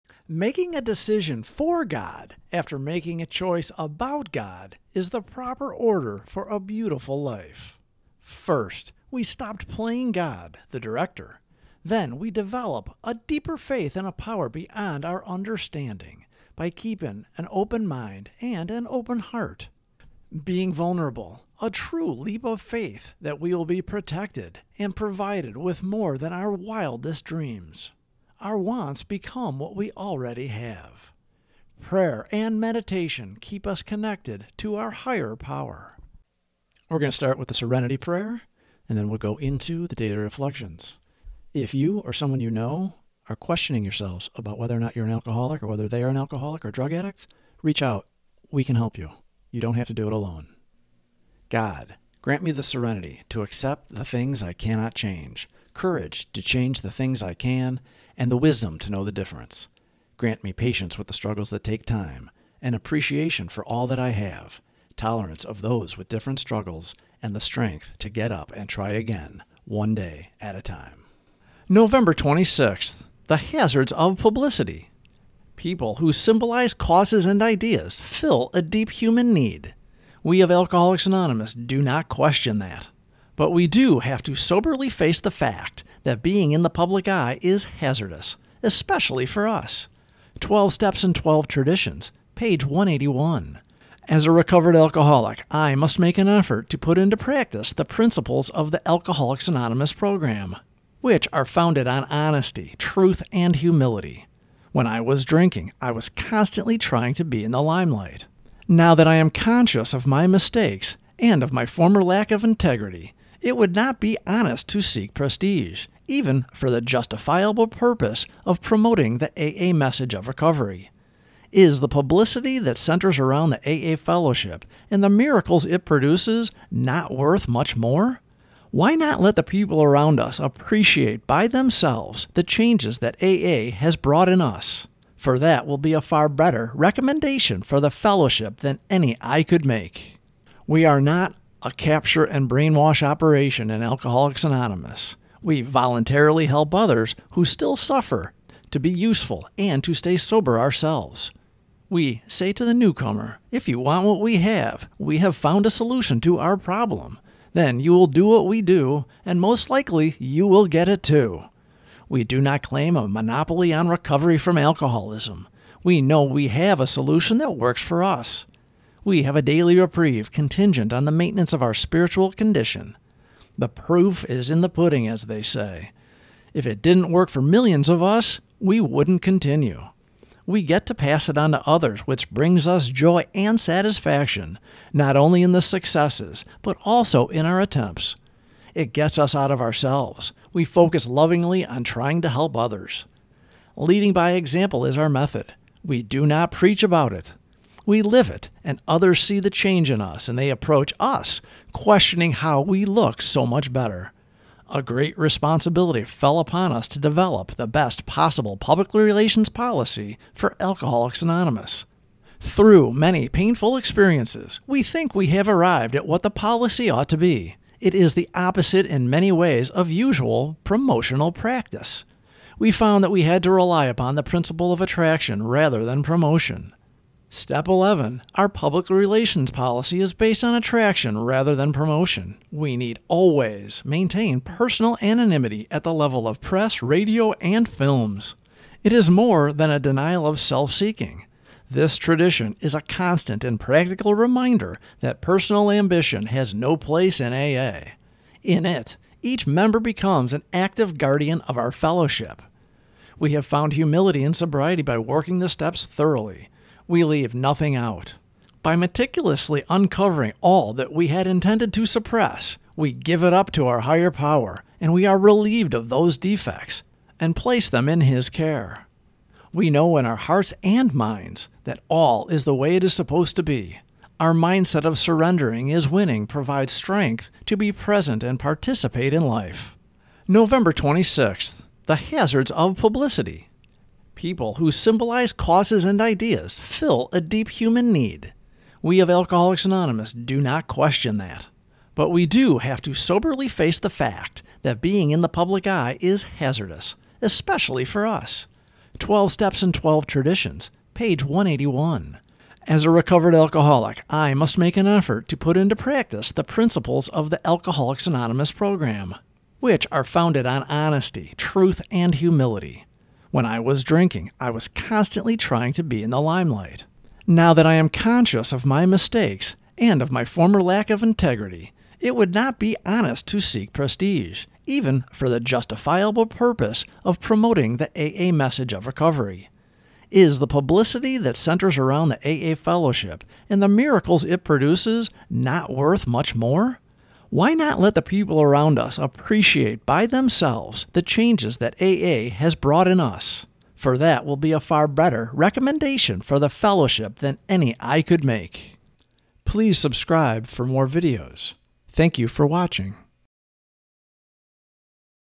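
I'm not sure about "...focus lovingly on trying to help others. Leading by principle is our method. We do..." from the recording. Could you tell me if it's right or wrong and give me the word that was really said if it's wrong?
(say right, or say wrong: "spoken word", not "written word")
wrong: "example", not "principle".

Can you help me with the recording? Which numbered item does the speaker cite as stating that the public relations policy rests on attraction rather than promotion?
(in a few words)
Step 11.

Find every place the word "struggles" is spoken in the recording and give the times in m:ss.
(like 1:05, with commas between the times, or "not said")
1:01, 1:06.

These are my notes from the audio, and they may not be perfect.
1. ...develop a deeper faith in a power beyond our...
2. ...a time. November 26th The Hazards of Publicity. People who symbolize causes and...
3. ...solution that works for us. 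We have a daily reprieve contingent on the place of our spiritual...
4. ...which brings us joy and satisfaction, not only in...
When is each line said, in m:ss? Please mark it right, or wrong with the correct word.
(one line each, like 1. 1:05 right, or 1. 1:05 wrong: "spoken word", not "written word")
1. 0:12 right
2. 1:10 right
3. 2:46 wrong: "maintenance", not "place"
4. 3:02 right.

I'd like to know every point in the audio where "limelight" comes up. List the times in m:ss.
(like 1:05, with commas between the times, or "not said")
1:47, 5:16.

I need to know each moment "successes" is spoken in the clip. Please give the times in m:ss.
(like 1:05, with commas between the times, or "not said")
3:05.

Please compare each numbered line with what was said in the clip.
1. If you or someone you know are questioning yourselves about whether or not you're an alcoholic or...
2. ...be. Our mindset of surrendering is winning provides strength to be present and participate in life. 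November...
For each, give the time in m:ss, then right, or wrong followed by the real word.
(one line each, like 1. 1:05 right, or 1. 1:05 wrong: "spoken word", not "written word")
1. 0:41 right
2. 4:33 right.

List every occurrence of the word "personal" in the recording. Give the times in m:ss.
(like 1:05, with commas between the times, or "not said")
3:54, 4:05.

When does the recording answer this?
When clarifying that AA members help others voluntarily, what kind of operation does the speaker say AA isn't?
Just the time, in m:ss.
2:21.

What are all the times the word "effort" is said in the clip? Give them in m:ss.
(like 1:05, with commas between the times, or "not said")
1:36, 5:04.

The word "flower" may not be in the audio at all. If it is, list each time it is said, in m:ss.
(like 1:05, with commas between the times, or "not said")
not said.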